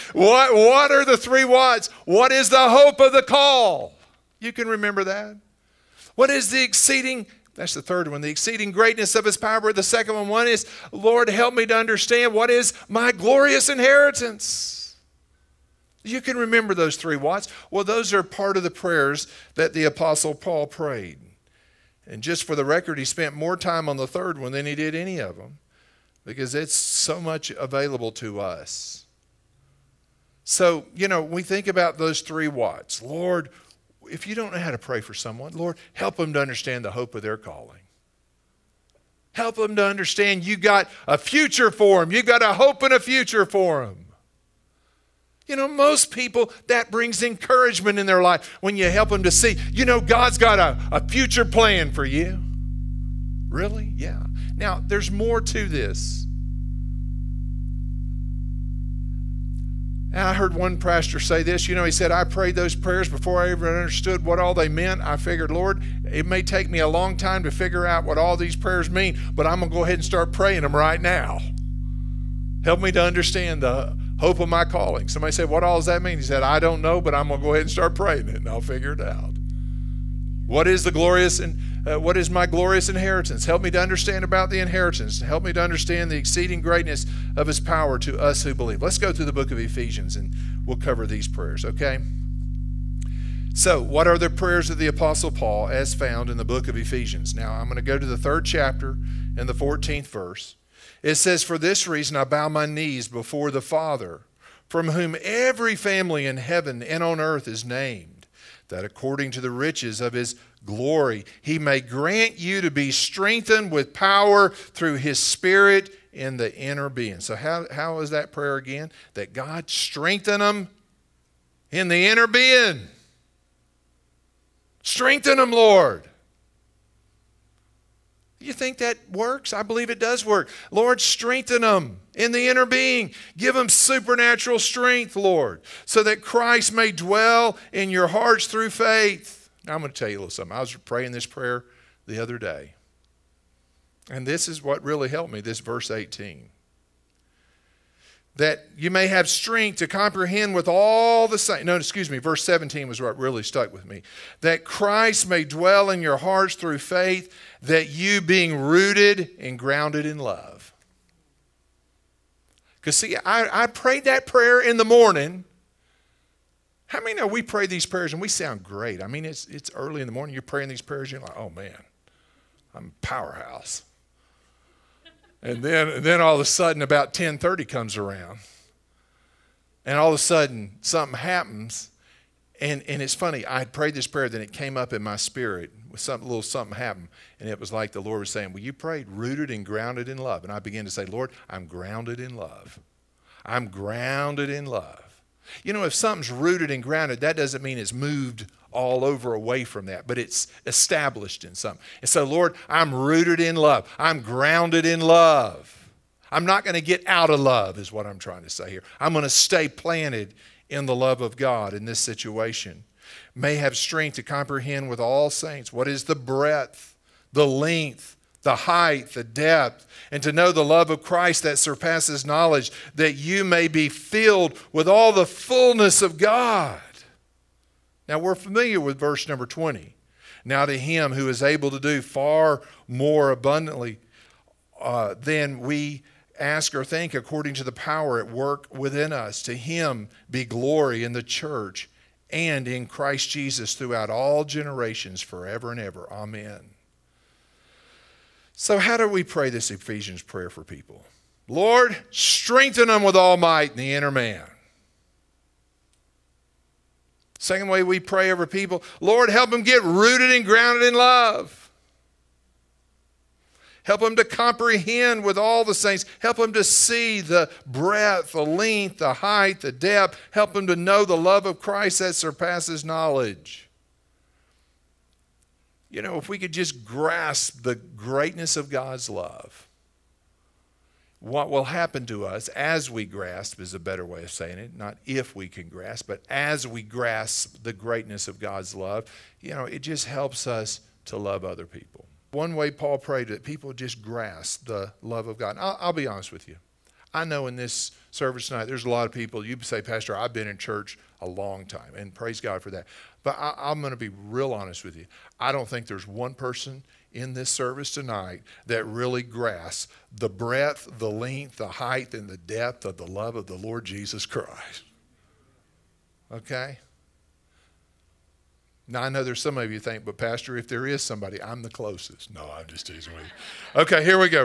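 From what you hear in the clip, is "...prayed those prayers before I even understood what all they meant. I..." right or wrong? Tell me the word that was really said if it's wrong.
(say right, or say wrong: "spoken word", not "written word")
right.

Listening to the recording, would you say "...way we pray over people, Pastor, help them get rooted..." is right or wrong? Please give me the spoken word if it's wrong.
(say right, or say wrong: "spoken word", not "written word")
wrong: "Lord", not "Pastor".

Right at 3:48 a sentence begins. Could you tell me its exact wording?
Now, we're familiar with verse number 20.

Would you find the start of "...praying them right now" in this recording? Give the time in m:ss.
1:10.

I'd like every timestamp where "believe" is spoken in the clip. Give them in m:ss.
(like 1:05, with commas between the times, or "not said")
1:28, 2:09.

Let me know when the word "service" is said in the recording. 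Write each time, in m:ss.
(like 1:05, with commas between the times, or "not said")
4:58, 5:07.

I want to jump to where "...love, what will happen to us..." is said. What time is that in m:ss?
4:39.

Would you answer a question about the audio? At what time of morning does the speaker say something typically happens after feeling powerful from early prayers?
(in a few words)
10:30.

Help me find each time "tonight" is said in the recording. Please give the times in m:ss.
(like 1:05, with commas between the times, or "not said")
4:58, 5:07.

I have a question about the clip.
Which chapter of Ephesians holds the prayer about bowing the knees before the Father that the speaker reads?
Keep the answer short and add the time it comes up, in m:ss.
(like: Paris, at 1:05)
Third chapter, at 1:38.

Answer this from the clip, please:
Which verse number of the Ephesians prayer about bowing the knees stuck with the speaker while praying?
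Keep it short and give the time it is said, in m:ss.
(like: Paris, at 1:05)
17, at 2:32.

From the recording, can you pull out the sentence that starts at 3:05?
Some little something happened, and it was like the Lord was saying, Well, you prayed rooted and grounded in love.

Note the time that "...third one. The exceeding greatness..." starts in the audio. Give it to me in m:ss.
0:07.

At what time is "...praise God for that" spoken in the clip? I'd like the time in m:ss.
5:02.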